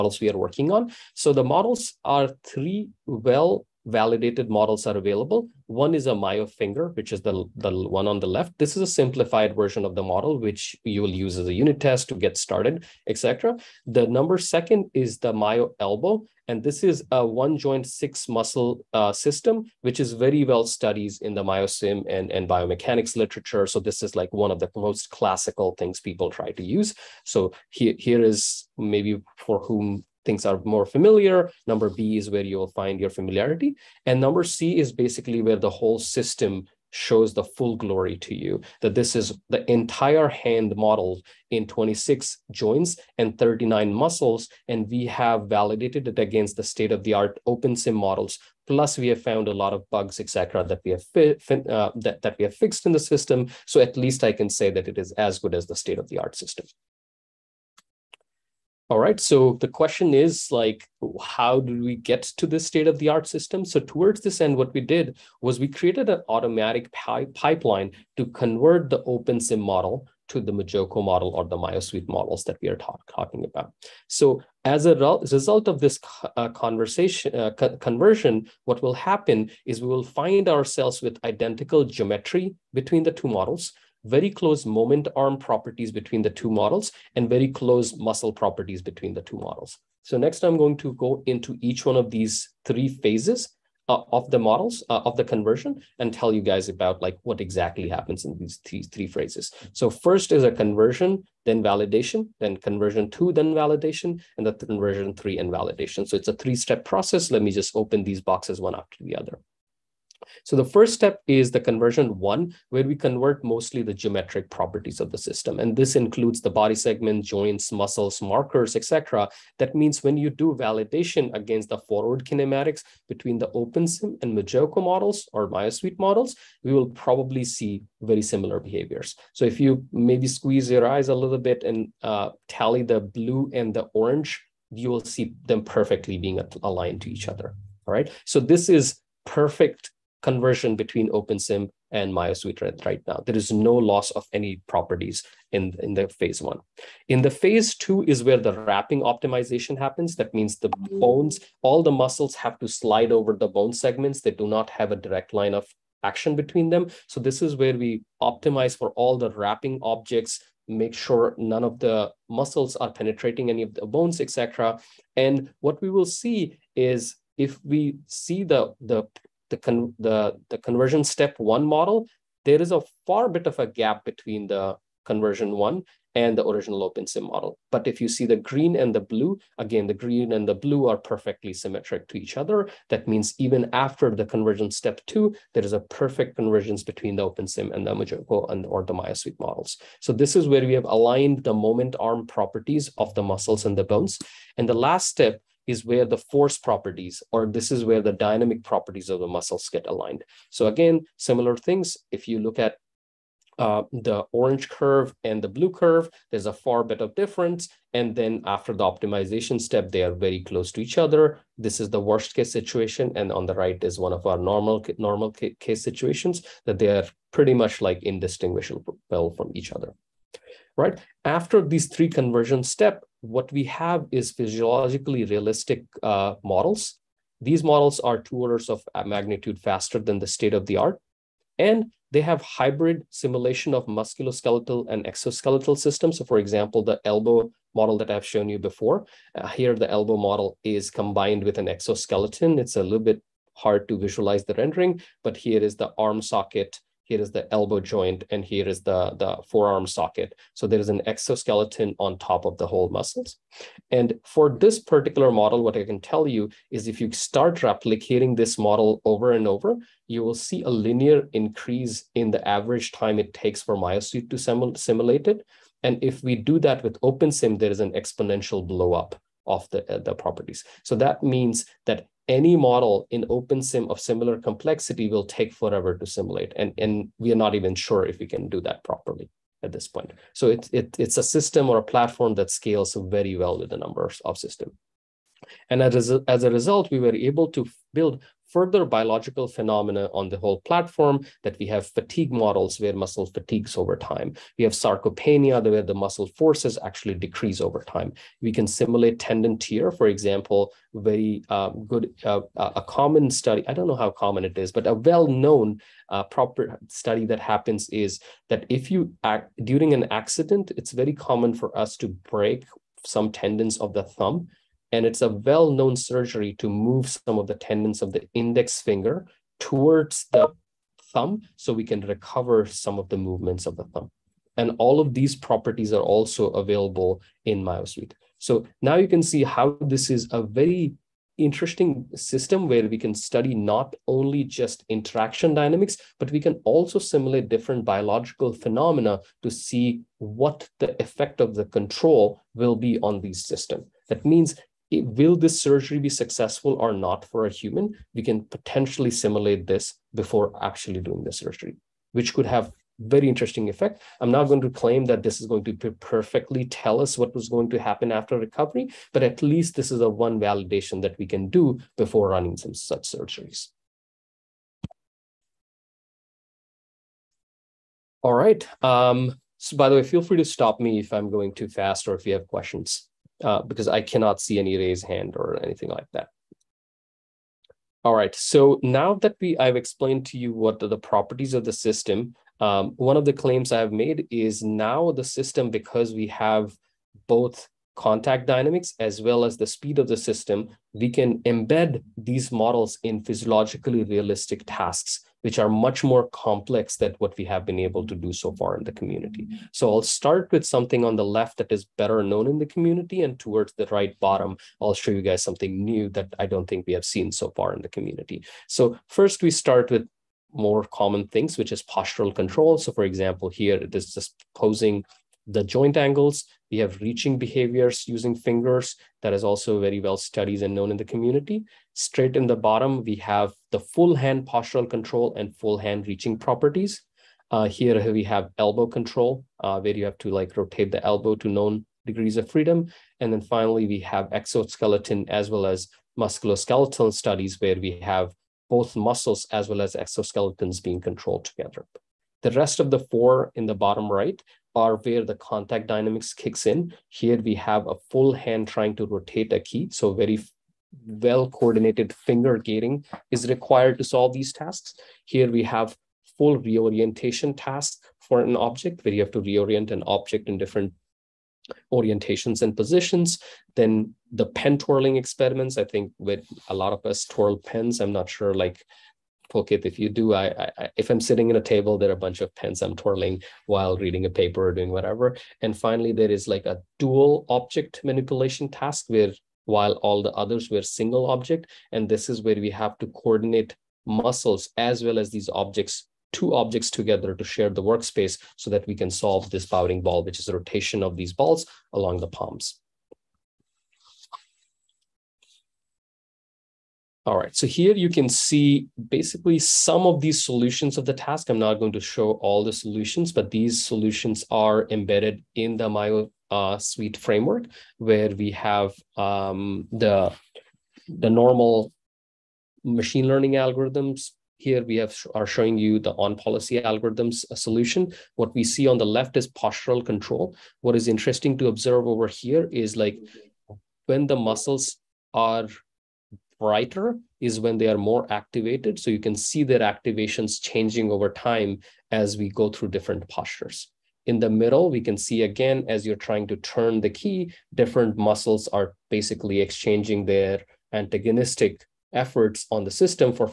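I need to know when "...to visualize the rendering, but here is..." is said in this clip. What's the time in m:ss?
4:03.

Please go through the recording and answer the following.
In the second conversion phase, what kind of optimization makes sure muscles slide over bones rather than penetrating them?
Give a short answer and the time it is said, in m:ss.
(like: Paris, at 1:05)
Wrapping optimization, at 2:28.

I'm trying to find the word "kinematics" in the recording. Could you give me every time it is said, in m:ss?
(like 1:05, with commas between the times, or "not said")
2:02.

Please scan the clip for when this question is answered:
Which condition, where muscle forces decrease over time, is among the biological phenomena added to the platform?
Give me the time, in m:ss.
4:54.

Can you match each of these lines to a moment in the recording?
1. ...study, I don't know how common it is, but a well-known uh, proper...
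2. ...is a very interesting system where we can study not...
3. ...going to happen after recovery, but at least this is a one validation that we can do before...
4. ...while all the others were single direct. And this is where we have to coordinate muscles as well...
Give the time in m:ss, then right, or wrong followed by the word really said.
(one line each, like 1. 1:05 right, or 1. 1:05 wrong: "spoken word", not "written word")
1. 5:03 right
2. 5:30 right
3. 5:57 right
4. 7:59 wrong: "object", not "direct".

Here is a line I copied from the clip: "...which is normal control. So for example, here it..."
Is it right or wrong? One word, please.
wrong.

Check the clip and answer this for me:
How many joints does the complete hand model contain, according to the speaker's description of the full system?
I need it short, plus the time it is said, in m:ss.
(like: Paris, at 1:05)
26, at 0:41.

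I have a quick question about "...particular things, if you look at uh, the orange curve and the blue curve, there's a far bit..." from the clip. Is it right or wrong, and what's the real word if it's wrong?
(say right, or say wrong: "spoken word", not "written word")
wrong: "similar", not "particular".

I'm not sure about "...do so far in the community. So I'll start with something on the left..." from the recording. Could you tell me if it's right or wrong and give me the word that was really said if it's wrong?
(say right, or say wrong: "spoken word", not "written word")
right.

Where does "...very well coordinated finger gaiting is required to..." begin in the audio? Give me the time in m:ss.
7:30.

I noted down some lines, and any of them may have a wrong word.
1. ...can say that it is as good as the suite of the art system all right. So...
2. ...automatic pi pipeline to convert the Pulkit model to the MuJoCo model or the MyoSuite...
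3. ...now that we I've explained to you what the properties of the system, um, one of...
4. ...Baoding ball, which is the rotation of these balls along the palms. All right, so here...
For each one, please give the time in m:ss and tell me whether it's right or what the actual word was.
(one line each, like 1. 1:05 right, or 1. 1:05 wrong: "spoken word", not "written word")
1. 0:54 wrong: "state", not "suite"
2. 1:06 wrong: "OpenSim", not "Pulkit"
3. 6:18 right
4. 8:09 right.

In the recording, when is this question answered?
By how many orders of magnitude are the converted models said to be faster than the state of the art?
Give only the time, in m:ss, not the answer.
3:48.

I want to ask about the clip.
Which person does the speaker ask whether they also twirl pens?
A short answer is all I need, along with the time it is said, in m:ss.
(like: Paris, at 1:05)
Pulkit, at 7:49.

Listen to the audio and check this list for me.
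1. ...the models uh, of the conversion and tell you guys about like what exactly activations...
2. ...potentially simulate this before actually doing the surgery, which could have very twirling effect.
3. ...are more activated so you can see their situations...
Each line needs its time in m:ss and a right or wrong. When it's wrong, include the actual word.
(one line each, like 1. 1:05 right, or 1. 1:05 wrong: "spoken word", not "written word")
1. 1:34 wrong: "happens", not "activations"
2. 5:48 wrong: "interesting", not "twirling"
3. 8:47 wrong: "activations", not "situations".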